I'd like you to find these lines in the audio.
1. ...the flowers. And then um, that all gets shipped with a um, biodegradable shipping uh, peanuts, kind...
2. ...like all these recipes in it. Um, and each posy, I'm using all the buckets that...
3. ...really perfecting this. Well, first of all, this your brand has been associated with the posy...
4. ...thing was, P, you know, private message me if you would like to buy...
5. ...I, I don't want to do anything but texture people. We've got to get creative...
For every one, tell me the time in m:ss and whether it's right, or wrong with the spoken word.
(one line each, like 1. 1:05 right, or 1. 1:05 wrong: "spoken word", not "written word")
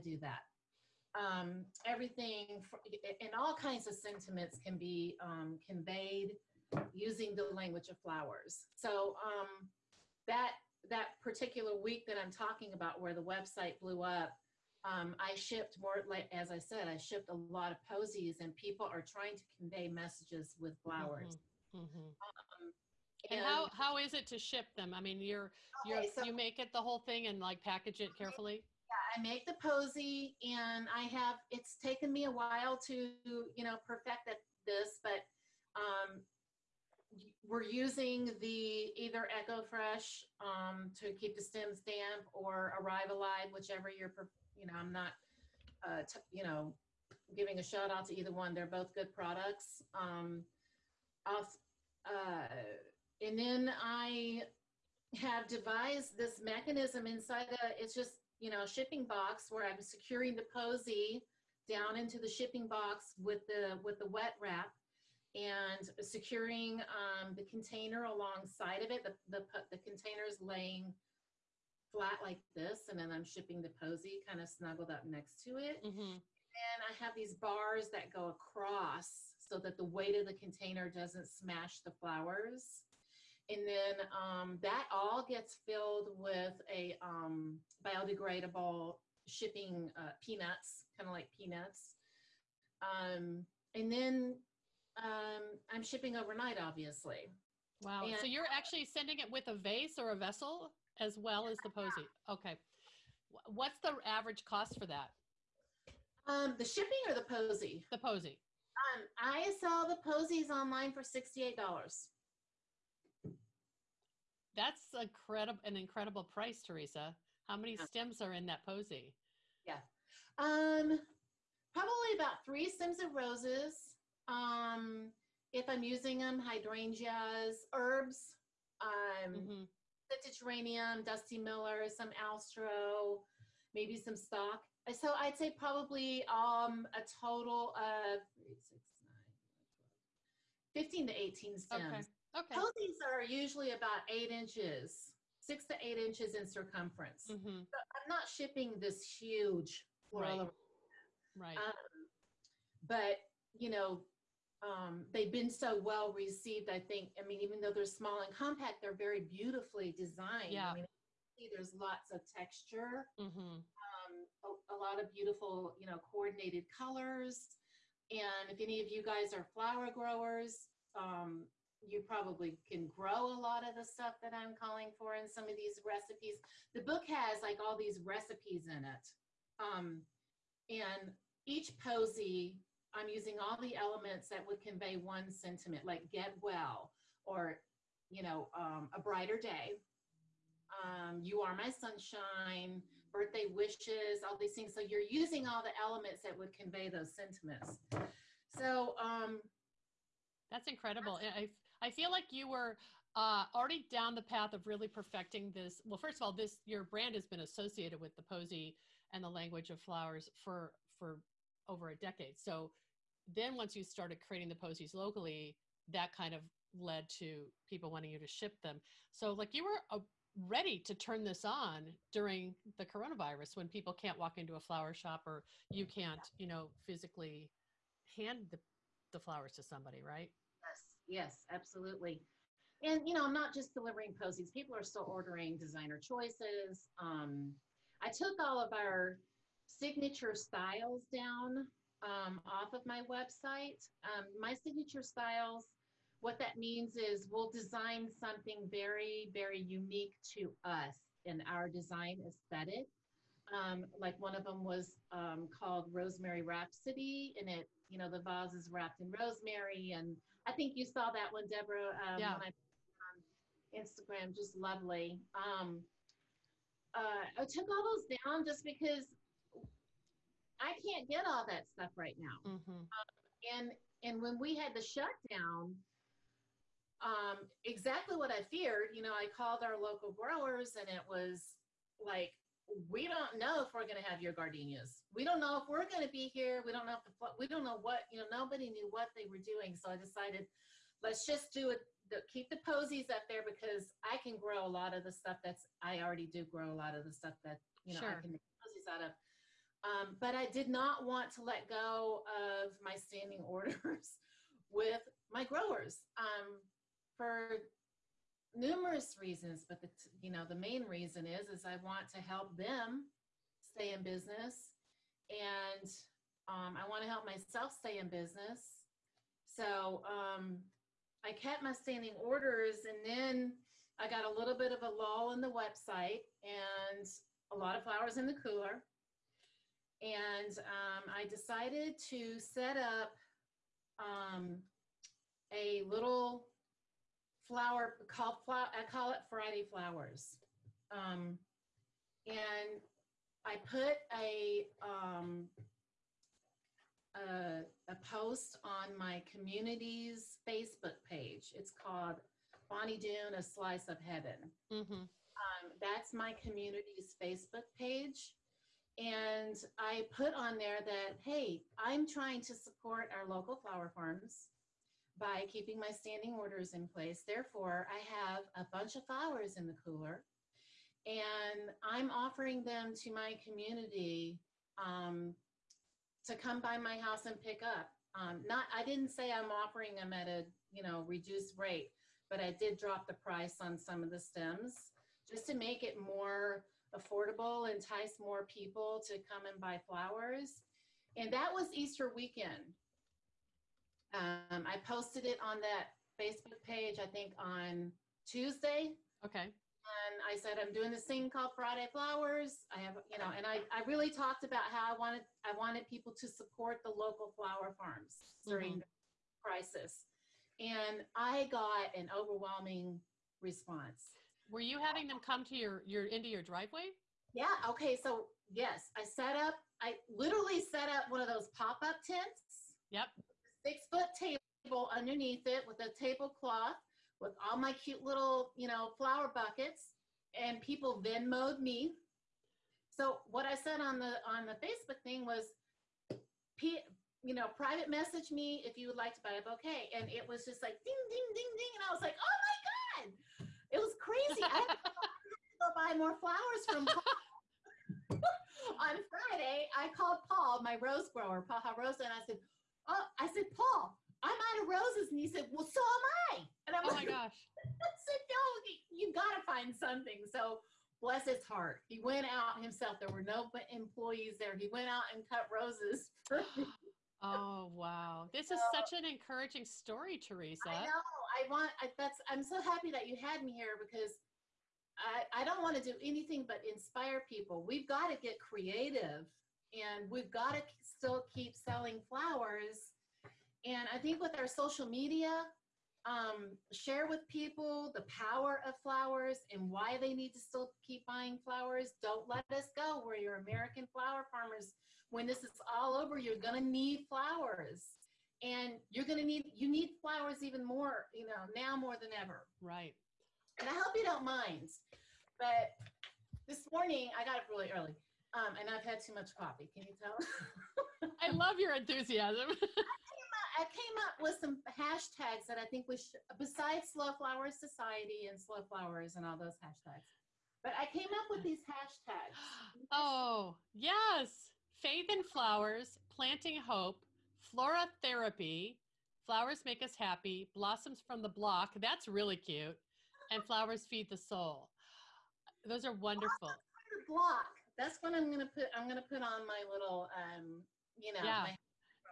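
1. 1:21 wrong: "filled", not "shipped"
2. 2:57 wrong: "elements", not "buckets"
3. 3:24 right
4. 7:15 right
5. 7:54 wrong: "inspire", not "texture".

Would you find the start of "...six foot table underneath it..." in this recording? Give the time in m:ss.
7:03.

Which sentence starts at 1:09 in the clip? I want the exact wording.
The, the, the container is laying flat like this, and then I'm shipping the posy kind of snuggled up next to it.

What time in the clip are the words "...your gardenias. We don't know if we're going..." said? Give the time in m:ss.
4:44.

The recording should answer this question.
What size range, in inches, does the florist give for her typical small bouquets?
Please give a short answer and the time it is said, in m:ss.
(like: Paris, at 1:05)
6 to 8 inches, at 2:25.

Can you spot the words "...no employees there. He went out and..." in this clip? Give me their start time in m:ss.
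7:43.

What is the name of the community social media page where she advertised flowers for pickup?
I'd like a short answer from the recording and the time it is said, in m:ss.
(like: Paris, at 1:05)
Bonny Doon, A Slice of Heaven, at 5:52.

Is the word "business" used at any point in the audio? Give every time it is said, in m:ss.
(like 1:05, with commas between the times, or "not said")
5:14, 5:18.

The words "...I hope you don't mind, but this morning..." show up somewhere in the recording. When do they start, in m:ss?
8:23.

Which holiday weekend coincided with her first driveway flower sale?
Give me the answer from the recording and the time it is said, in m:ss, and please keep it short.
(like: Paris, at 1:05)
Easter, at 6:31.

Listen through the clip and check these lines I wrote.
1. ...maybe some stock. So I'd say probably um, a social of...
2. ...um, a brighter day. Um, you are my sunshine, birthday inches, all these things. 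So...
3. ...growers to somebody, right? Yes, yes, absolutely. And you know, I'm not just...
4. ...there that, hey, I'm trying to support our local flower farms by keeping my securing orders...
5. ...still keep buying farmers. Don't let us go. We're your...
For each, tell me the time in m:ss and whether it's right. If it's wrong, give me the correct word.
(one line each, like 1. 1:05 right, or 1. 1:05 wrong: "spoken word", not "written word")
1. 2:13 wrong: "total", not "social"
2. 3:08 wrong: "wishes", not "inches"
3. 3:49 wrong: "flowers", not "growers"
4. 6:00 wrong: "standing", not "securing"
5. 8:10 wrong: "flowers", not "farmers".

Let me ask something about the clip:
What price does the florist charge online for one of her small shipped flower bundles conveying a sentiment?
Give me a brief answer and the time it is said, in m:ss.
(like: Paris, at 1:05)
$68, at 1:51.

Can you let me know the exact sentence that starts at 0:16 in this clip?
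Like as I said, I shipped a lot of posies, and people are trying to convey messages with flowers.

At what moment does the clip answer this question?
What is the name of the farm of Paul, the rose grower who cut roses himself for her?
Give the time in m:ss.
7:31.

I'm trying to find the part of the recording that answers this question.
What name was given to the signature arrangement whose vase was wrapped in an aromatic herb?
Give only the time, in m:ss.
4:15.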